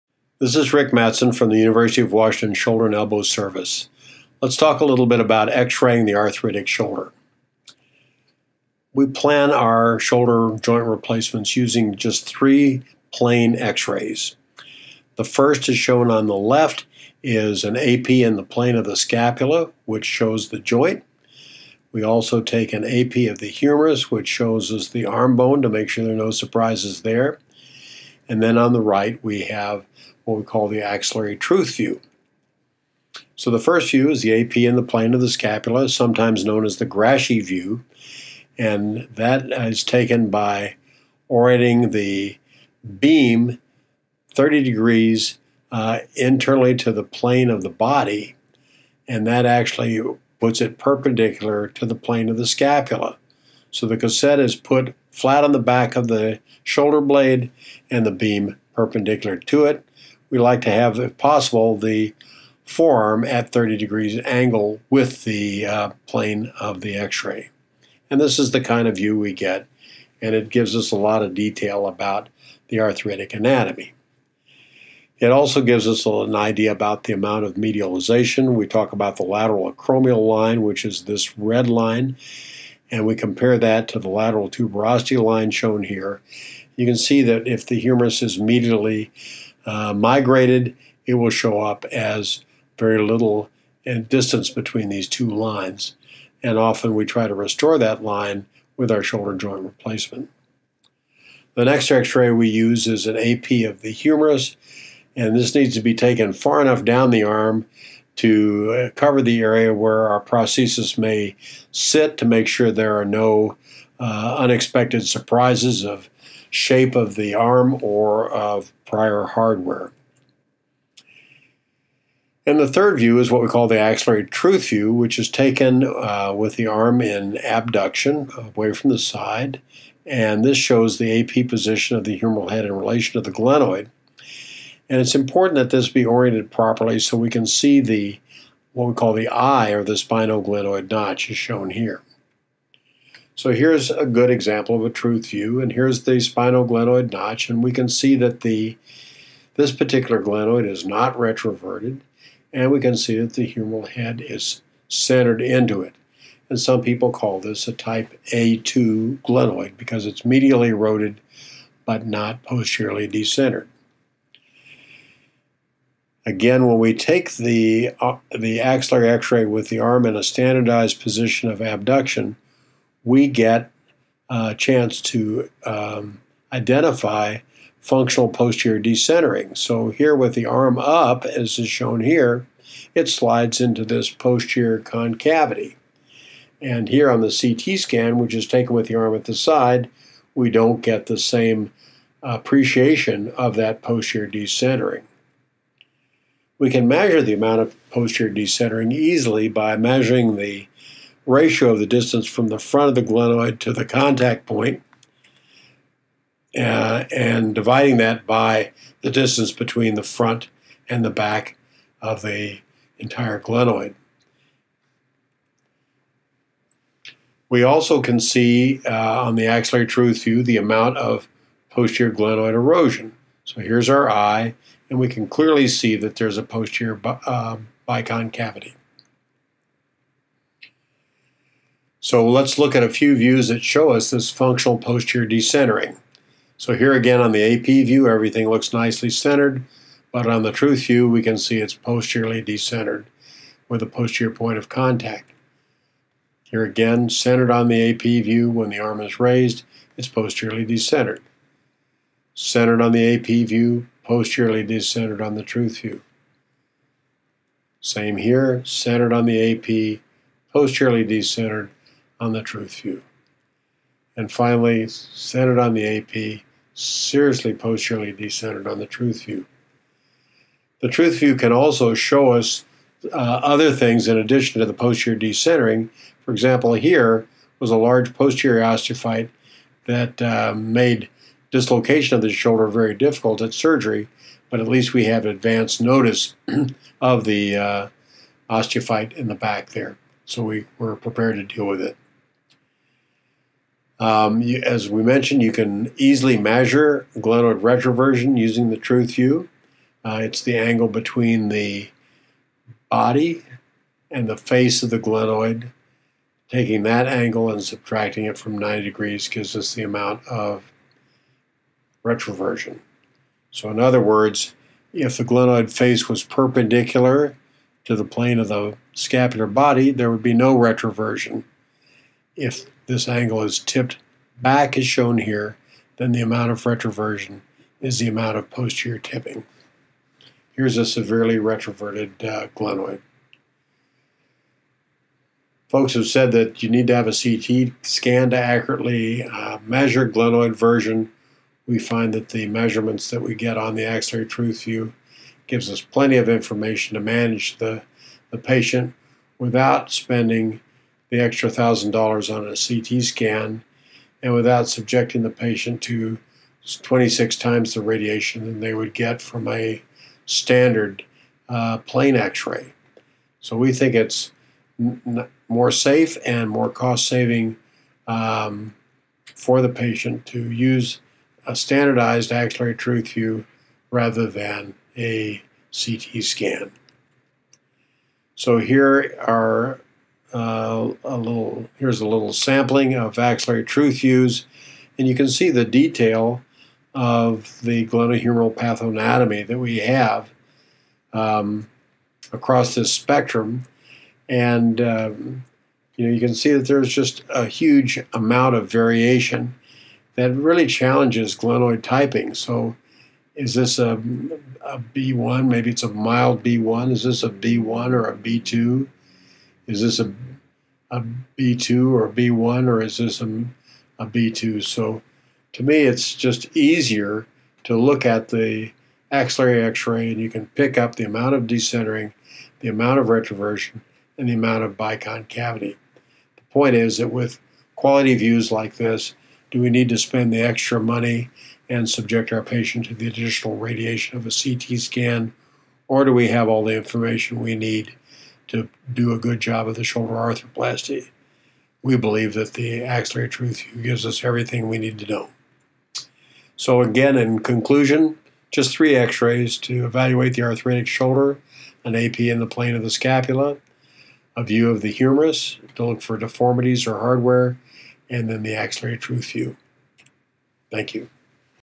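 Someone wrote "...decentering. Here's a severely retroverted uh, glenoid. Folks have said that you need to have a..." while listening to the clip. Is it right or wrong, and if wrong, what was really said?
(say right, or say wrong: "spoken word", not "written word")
wrong: "tipping", not "decentering".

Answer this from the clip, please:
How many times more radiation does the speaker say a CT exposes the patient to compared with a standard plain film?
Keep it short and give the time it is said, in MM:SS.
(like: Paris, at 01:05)
26, at 05:56.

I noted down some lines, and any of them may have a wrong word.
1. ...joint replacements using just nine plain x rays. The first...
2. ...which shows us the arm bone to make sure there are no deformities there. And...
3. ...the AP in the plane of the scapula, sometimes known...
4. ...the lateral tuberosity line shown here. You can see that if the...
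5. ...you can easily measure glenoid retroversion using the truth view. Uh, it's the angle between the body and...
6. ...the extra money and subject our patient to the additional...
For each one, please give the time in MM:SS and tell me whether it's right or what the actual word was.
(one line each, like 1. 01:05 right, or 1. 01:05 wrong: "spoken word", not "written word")
1. 00:10 wrong: "three", not "nine"
2. 00:24 wrong: "surprises", not "deformities"
3. 00:34 right
4. 01:23 right
5. 04:55 right
6. 07:10 right.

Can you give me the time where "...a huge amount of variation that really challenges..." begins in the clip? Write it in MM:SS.
06:37.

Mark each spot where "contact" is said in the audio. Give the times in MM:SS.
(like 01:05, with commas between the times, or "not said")
03:23, 04:04.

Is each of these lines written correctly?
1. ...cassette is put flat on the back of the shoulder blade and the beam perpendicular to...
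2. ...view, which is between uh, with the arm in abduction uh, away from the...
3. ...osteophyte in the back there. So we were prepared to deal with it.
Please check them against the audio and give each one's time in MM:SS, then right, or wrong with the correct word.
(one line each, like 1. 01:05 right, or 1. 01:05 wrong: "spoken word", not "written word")
1. 00:53 right
2. 02:04 wrong: "taken", not "between"
3. 04:48 right.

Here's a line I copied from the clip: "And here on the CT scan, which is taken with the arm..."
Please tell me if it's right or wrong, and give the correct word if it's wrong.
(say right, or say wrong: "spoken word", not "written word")
right.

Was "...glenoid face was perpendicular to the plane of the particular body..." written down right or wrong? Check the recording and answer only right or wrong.
wrong.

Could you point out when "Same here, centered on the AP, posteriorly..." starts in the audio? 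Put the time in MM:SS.
04:17.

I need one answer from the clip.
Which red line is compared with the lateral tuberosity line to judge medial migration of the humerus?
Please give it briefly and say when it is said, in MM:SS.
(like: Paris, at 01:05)
lateral acromial line, at 01:19.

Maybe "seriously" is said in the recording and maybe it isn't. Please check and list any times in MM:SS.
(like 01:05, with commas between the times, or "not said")
04:26.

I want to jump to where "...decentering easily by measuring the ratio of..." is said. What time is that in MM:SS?
03:18.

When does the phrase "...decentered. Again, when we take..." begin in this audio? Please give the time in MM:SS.
02:43.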